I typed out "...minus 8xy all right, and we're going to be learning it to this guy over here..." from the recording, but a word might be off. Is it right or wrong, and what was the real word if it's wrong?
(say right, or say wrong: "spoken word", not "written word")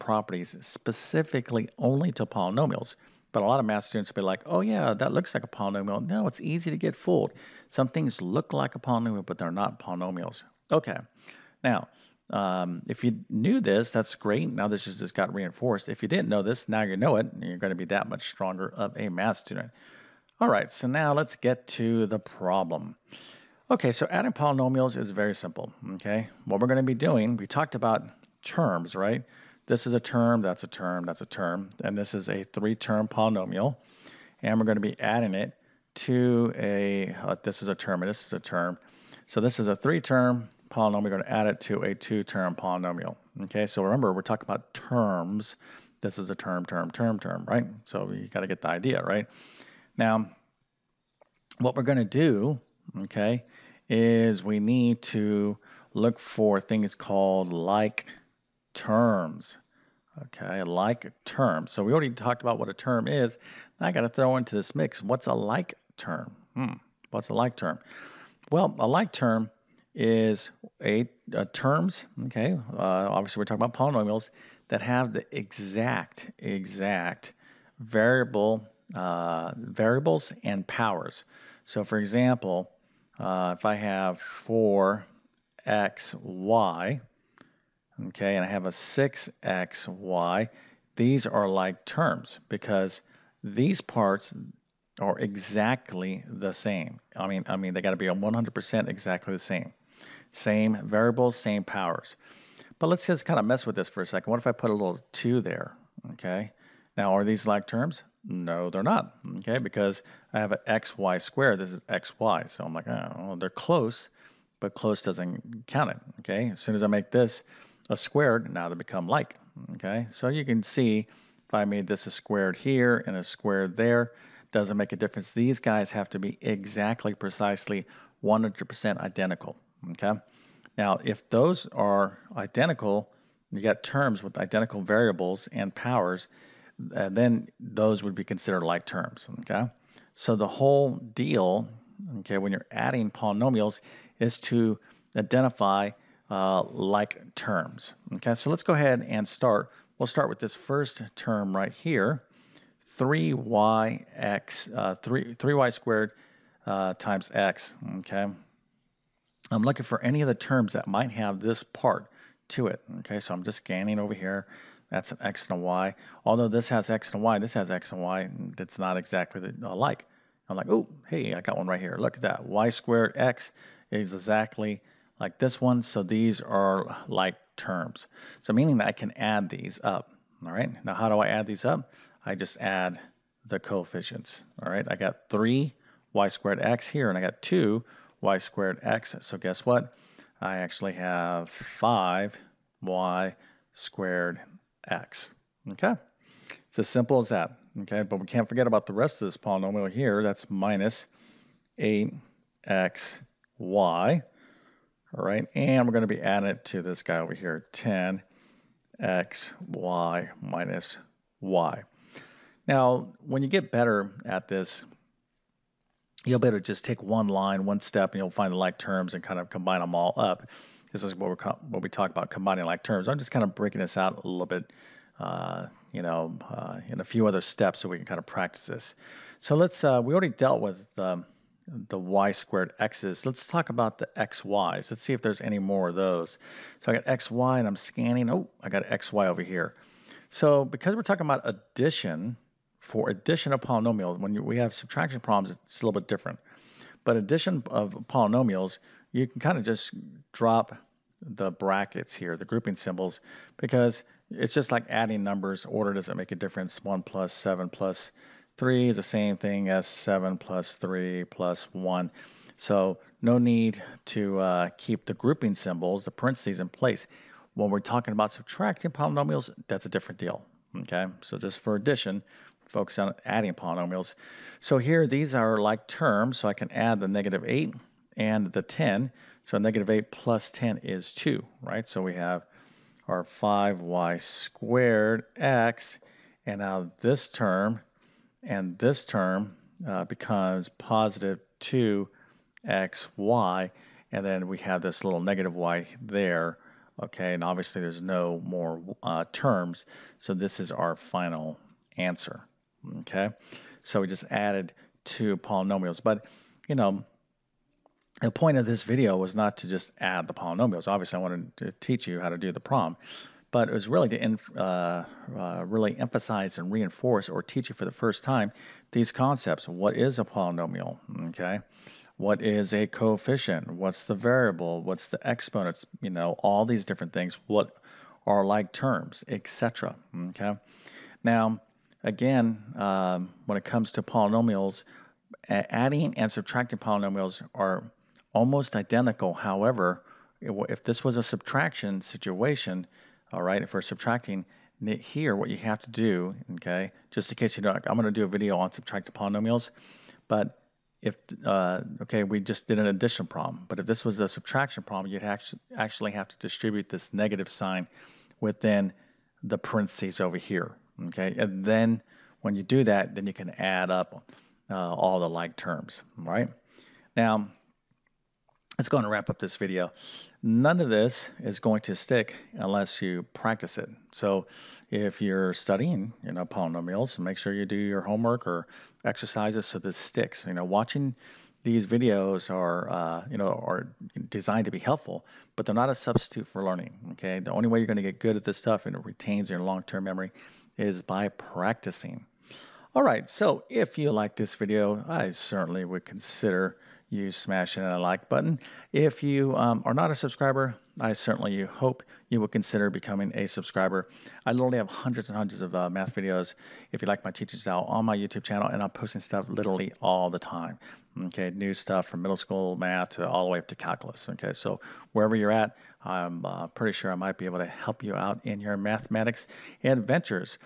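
wrong: "adding", not "learning".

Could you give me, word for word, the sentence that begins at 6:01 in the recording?
And then when you do that, then you can add up uh, all the like terms, right?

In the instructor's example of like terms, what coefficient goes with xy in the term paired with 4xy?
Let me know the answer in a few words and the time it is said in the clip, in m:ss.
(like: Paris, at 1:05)
6, at 1:28.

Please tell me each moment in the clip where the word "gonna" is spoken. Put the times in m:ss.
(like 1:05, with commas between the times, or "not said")
0:17, 0:26.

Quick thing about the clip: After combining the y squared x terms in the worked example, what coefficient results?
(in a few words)
5.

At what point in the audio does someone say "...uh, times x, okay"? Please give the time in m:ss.
2:36.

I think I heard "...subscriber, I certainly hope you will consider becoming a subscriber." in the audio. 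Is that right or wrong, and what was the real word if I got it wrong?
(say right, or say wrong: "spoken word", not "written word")
right.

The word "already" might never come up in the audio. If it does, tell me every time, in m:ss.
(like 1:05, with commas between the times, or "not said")
1:01, 3:50.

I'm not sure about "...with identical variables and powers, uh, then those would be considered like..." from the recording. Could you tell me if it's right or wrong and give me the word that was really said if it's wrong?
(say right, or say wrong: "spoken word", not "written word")
right.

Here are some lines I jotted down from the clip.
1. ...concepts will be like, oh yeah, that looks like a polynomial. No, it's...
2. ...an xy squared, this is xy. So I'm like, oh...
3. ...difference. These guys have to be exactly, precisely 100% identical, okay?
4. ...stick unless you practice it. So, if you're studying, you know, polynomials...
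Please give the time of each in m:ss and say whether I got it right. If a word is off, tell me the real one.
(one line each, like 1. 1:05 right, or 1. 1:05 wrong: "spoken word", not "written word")
1. 0:03 wrong: "students", not "concepts"
2. 1:50 right
3. 2:04 right
4. 6:11 right.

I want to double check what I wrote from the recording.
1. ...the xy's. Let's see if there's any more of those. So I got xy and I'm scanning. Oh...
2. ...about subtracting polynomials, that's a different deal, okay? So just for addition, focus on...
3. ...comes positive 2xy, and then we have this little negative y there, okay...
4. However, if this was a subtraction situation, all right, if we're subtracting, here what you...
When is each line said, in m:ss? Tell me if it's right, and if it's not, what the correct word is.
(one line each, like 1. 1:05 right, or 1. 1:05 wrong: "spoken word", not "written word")
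1. 3:53 right
2. 4:28 right
3. 4:50 wrong: "becomes", not "comes"
4. 5:39 right.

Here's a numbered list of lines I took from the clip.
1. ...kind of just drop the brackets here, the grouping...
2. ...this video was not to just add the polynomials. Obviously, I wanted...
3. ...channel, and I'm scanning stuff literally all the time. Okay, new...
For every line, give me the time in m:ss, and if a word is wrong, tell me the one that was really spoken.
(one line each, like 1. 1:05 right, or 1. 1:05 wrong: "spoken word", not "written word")
1. 4:09 right
2. 5:08 right
3. 6:48 wrong: "posting", not "scanning".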